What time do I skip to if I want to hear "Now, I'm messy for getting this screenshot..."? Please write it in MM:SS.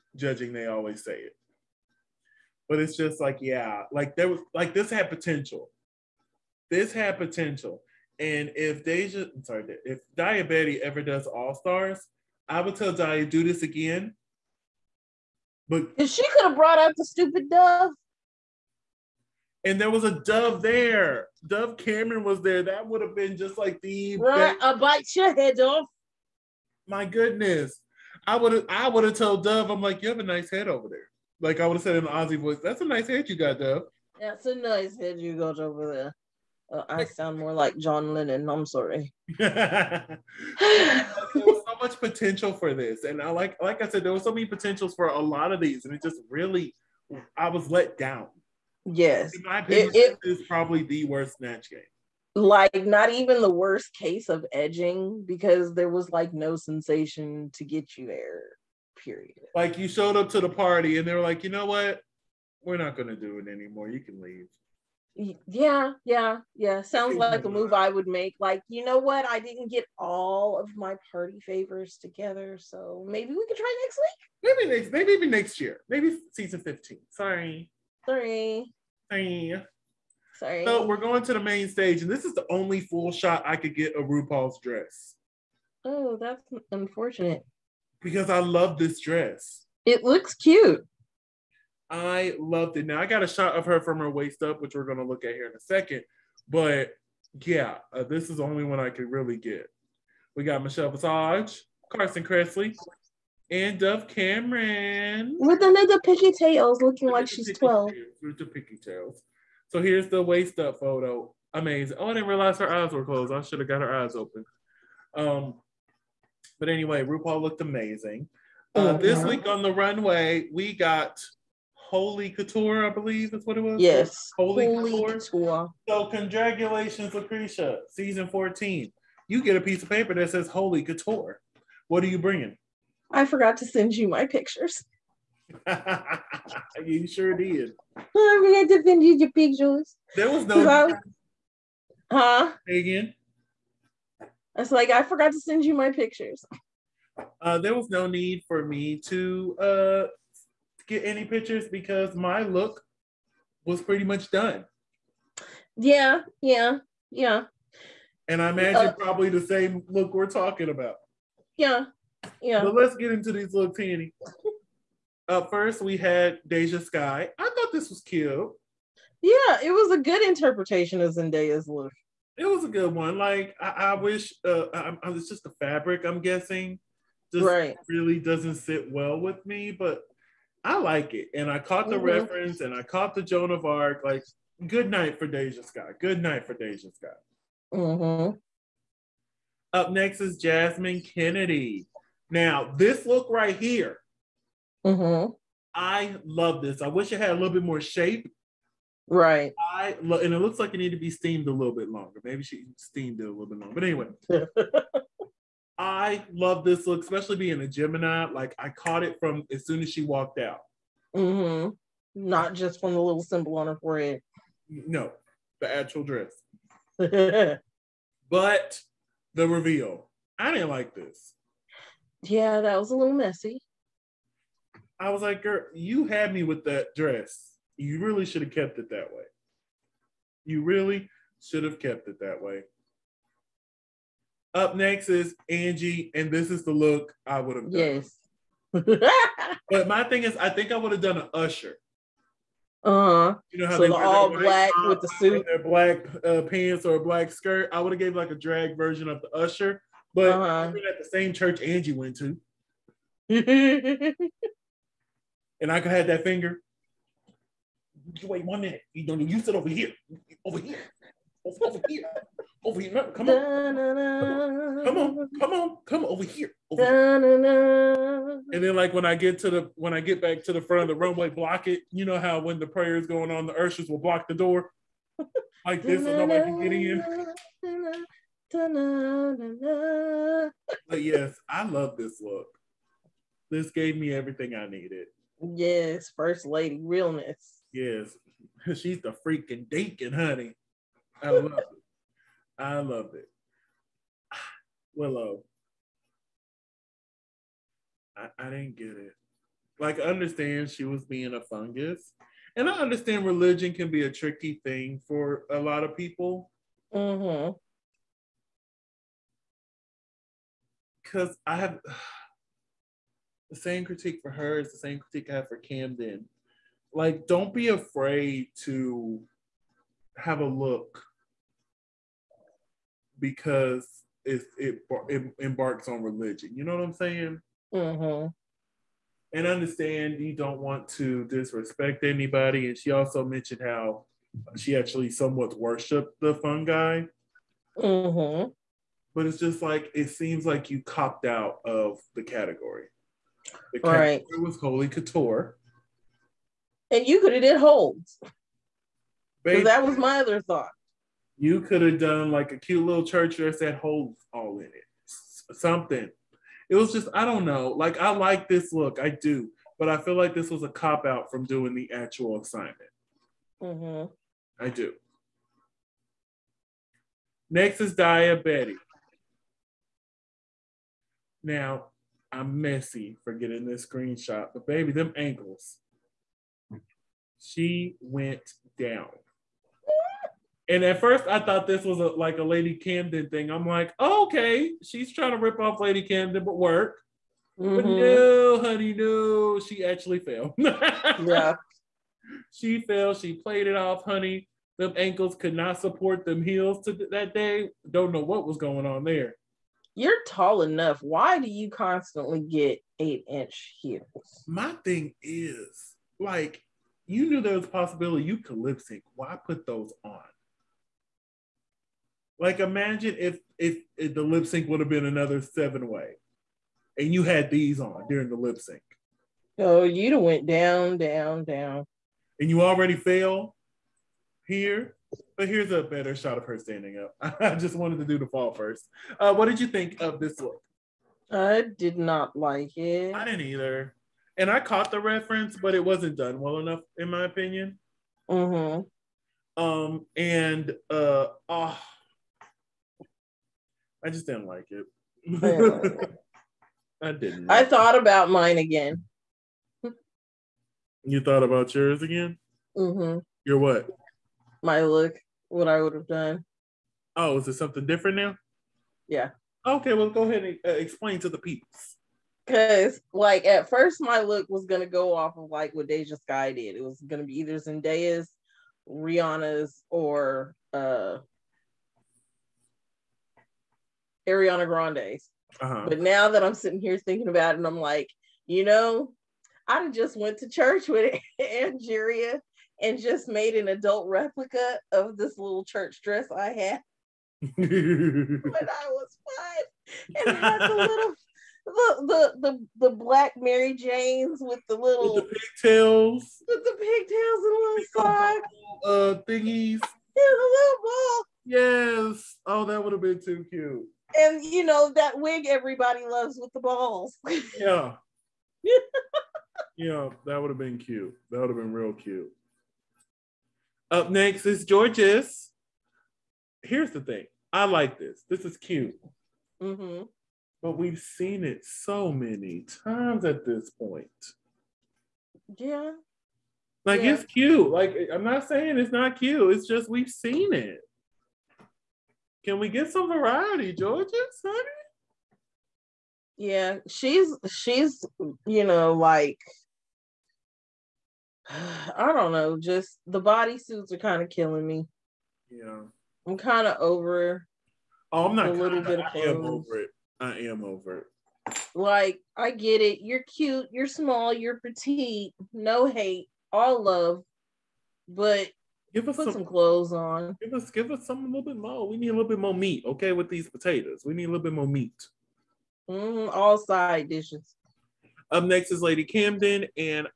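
06:11.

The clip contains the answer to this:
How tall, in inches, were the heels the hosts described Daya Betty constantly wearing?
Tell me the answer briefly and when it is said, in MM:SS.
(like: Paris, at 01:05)
8, at 06:42.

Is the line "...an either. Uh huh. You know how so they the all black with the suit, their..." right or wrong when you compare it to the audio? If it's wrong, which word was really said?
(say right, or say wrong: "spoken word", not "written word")
wrong: "usher", not "either".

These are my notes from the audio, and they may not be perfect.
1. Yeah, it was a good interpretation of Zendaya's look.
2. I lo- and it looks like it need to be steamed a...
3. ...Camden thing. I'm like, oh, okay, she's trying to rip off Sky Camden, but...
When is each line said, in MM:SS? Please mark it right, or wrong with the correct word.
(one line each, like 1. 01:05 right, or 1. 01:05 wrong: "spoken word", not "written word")
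1. 02:49 right
2. 03:19 right
3. 06:22 wrong: "Lady", not "Sky".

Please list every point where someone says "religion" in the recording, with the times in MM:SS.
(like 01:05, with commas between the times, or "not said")
05:03, 05:26.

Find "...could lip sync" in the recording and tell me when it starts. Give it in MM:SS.
06:48.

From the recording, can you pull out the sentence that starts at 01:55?
Um, but anyway, RuPaul looked amazing.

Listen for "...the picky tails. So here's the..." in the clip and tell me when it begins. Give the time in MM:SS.
01:48.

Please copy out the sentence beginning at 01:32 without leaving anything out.
Now I got a shot of her from her waist up, which we're gonna look at here in a second.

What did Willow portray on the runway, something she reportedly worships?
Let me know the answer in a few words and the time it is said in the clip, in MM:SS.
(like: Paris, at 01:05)
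fungus, at 05:01.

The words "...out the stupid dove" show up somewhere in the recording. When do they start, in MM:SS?
00:16.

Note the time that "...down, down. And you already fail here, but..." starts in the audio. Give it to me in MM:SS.
07:00.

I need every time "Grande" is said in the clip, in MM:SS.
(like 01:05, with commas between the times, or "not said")
07:54.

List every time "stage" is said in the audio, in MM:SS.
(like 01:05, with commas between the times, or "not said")
01:21.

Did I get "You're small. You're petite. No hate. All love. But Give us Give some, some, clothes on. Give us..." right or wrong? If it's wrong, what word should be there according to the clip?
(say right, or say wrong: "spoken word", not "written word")
wrong: "Put", not "Give".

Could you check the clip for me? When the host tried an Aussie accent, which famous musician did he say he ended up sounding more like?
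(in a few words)
John Lennon.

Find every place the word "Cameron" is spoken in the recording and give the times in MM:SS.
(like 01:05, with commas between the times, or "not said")
00:21, 01:44.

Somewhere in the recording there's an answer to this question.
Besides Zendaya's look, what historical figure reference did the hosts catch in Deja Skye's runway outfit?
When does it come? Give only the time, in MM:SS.
03:03.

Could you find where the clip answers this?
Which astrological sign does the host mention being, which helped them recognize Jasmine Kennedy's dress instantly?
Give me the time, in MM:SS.
03:27.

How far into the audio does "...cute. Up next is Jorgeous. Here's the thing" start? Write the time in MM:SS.
08:31.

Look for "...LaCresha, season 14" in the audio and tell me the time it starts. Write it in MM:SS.
02:07.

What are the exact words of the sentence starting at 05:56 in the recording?
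It was just, I don't know.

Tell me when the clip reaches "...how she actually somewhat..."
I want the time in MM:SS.
05:33.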